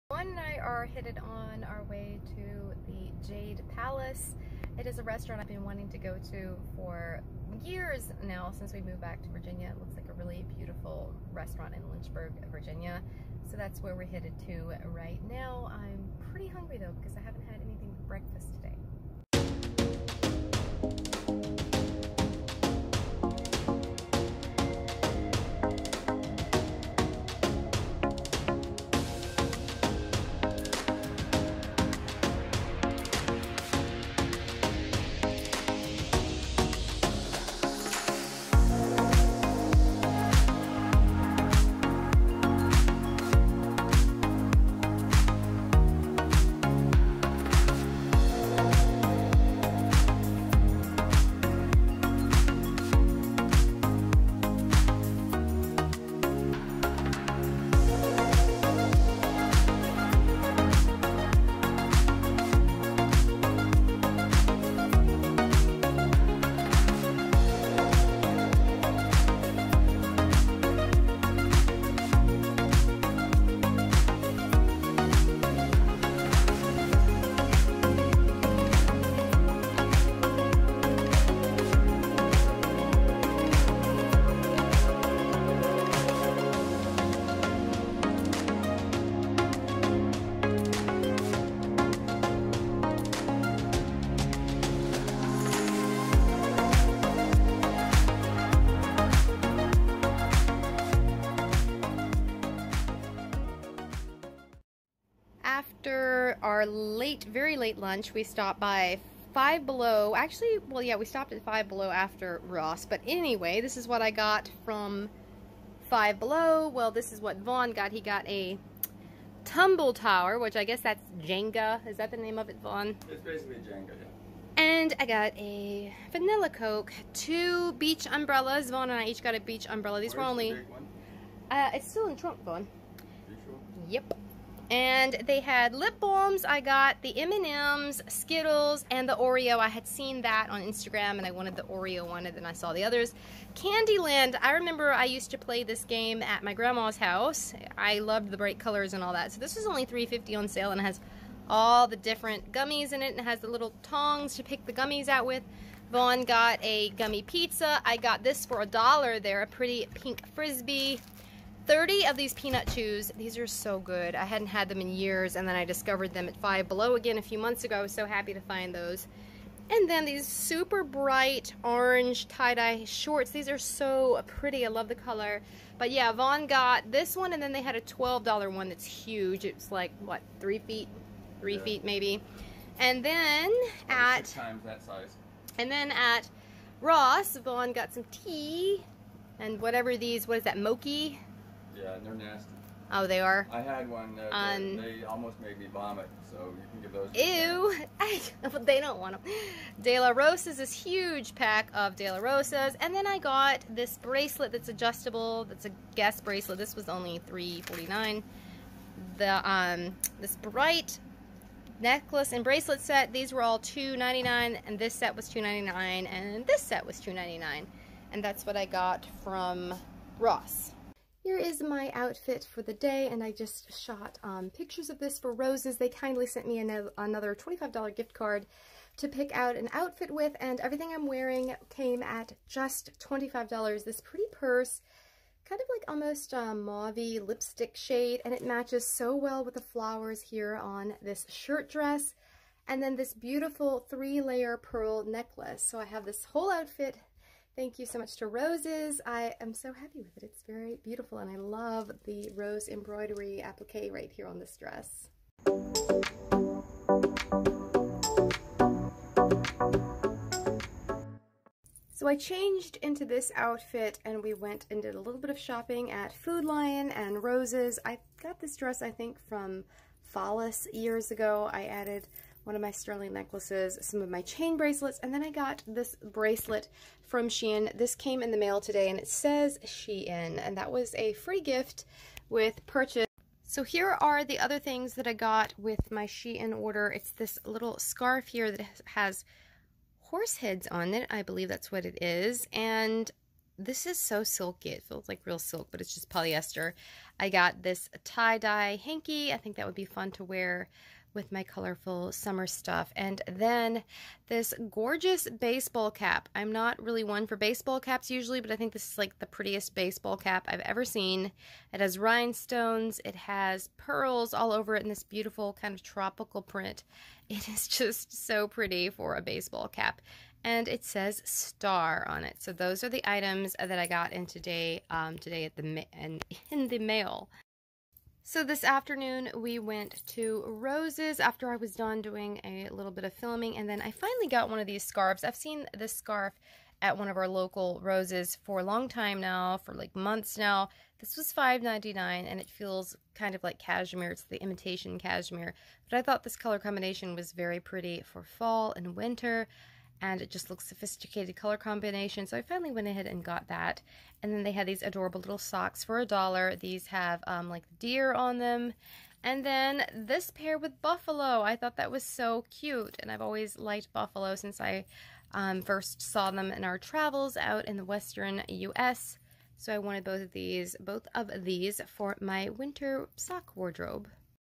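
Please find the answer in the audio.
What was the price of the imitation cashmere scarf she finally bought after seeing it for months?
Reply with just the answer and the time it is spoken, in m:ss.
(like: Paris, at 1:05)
$5.99, at 5:41.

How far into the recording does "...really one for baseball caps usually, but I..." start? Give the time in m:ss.
5:06.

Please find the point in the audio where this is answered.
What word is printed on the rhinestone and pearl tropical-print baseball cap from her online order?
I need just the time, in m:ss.
5:21.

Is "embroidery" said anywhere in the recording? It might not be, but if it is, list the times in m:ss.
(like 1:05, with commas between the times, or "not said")
4:12.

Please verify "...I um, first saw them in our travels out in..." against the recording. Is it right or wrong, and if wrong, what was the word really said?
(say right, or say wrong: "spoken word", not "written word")
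right.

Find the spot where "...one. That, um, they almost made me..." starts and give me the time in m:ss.
3:13.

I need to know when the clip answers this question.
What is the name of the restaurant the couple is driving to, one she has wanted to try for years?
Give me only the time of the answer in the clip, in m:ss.
0:03.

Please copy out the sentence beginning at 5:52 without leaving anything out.
So I finally went ahead and got that.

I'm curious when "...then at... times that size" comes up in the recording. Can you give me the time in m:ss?
3:03.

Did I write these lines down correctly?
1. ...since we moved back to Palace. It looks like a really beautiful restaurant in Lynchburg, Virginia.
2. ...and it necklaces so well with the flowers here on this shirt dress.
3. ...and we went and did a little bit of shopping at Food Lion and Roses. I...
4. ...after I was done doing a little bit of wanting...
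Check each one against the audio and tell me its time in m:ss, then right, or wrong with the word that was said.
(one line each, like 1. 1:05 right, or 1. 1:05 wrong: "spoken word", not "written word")
1. 0:08 wrong: "Virginia", not "Palace"
2. 3:58 wrong: "matches", not "necklaces"
3. 4:24 right
4. 5:31 wrong: "filming", not "wanting".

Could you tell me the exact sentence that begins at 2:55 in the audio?
But yeah, Vaughn got this one, and then they had a $12 one that's huge.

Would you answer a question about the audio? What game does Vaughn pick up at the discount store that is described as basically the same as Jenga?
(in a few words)
Tumble Tower.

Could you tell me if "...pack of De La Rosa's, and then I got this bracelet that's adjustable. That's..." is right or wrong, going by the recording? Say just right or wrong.
right.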